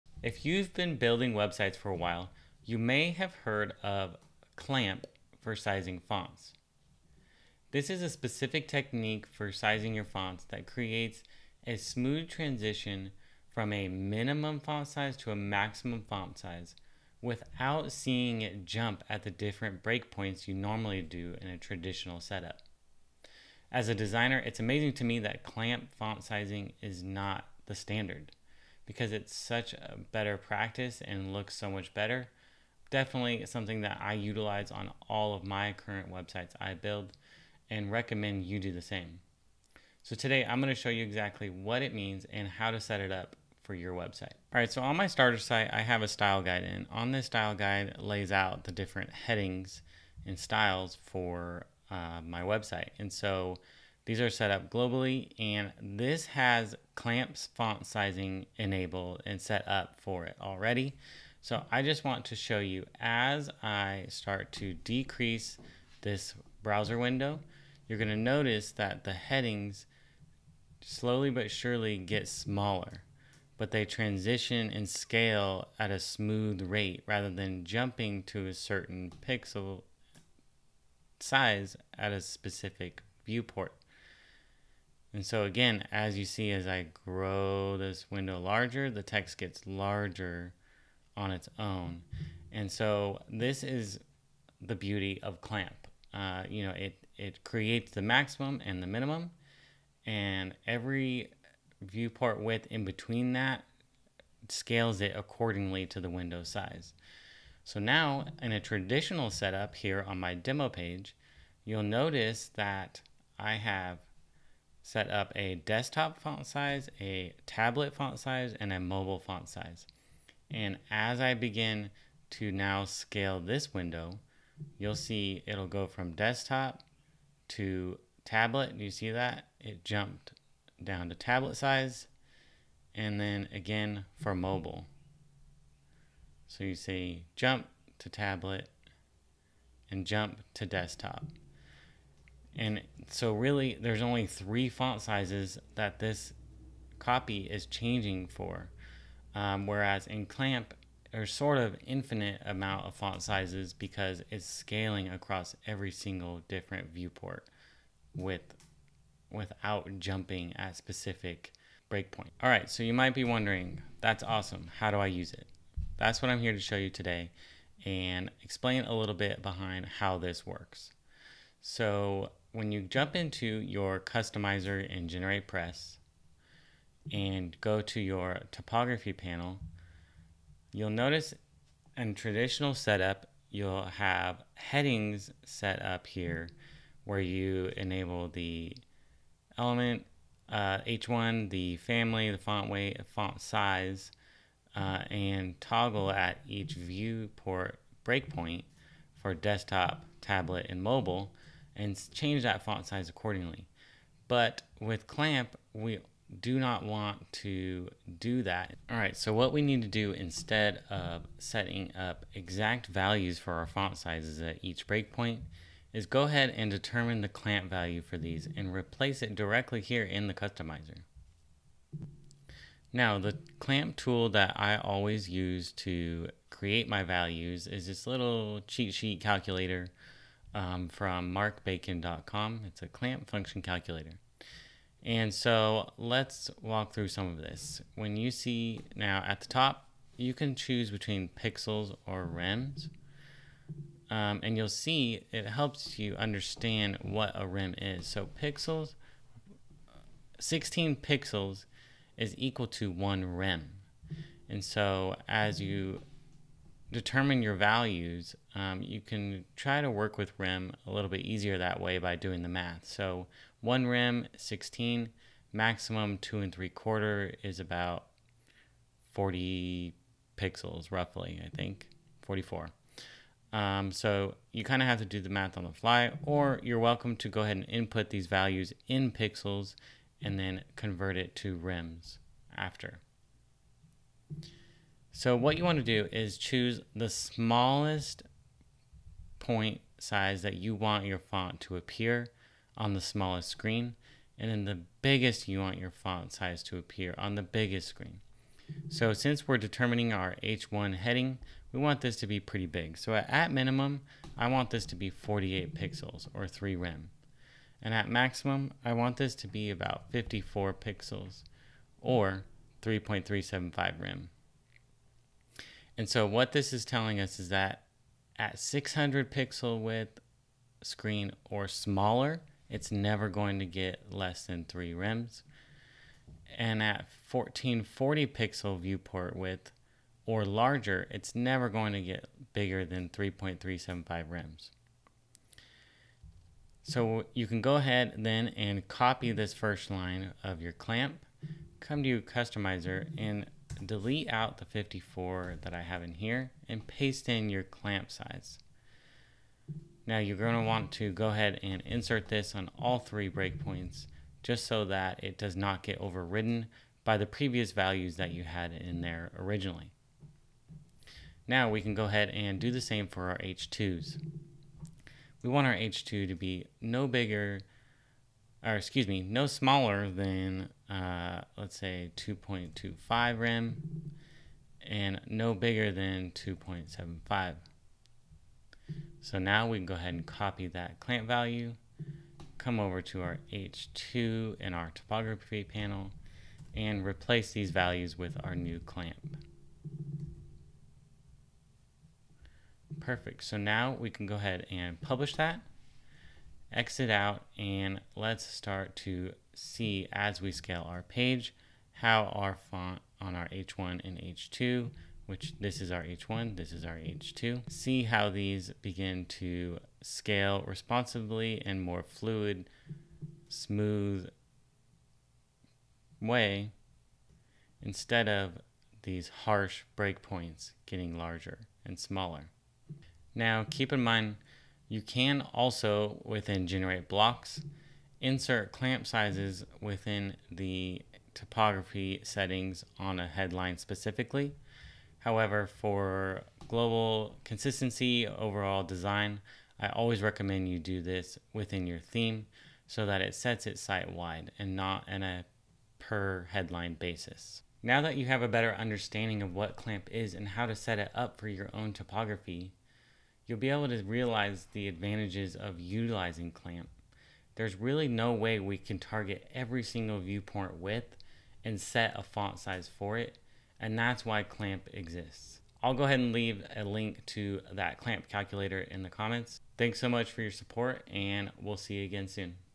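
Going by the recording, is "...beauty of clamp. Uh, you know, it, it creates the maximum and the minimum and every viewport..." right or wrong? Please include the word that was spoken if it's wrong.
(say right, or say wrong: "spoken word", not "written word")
right.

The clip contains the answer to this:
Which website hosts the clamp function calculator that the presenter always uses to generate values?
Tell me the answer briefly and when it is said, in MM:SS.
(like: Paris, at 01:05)
marcbacon.com, at 03:51.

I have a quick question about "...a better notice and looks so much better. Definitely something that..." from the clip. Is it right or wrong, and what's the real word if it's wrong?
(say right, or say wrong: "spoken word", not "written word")
wrong: "practice", not "notice".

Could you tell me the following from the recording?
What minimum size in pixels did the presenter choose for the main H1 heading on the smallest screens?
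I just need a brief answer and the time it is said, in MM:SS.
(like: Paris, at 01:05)
48 pixels, at 05:05.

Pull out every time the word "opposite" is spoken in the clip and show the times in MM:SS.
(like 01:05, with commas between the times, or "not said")
not said.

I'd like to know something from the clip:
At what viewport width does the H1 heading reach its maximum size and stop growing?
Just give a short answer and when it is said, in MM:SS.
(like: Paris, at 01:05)
1440 pixels, at 05:27.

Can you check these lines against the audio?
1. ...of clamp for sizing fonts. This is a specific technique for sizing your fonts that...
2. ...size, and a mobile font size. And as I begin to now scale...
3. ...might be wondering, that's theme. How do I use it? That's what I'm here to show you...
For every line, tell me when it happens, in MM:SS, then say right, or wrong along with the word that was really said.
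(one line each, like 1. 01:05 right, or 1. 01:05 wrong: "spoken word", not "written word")
1. 00:03 right
2. 01:58 right
3. 02:42 wrong: "awesome", not "theme".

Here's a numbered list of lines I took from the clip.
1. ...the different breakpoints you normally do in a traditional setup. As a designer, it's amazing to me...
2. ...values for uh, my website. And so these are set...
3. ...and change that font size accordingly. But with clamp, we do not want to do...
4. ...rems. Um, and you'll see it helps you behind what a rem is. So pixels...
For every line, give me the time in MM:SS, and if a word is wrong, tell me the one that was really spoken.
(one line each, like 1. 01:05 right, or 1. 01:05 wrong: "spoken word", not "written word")
1. 00:19 right
2. 00:50 wrong: "styles", not "values"
3. 03:21 right
4. 04:02 wrong: "understand", not "behind".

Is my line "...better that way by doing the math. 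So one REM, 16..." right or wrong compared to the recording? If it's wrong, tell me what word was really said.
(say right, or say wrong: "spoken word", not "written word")
wrong: "easier", not "better".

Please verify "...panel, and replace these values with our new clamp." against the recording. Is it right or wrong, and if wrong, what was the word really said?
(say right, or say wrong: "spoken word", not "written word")
right.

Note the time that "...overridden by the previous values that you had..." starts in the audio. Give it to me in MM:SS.
05:55.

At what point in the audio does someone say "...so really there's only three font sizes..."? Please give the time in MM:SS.
02:23.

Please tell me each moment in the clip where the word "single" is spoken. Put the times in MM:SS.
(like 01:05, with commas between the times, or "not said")
02:35, 07:39.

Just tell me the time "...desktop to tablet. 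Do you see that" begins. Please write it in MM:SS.
02:06.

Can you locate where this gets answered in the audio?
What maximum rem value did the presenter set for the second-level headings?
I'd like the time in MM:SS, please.
06:16.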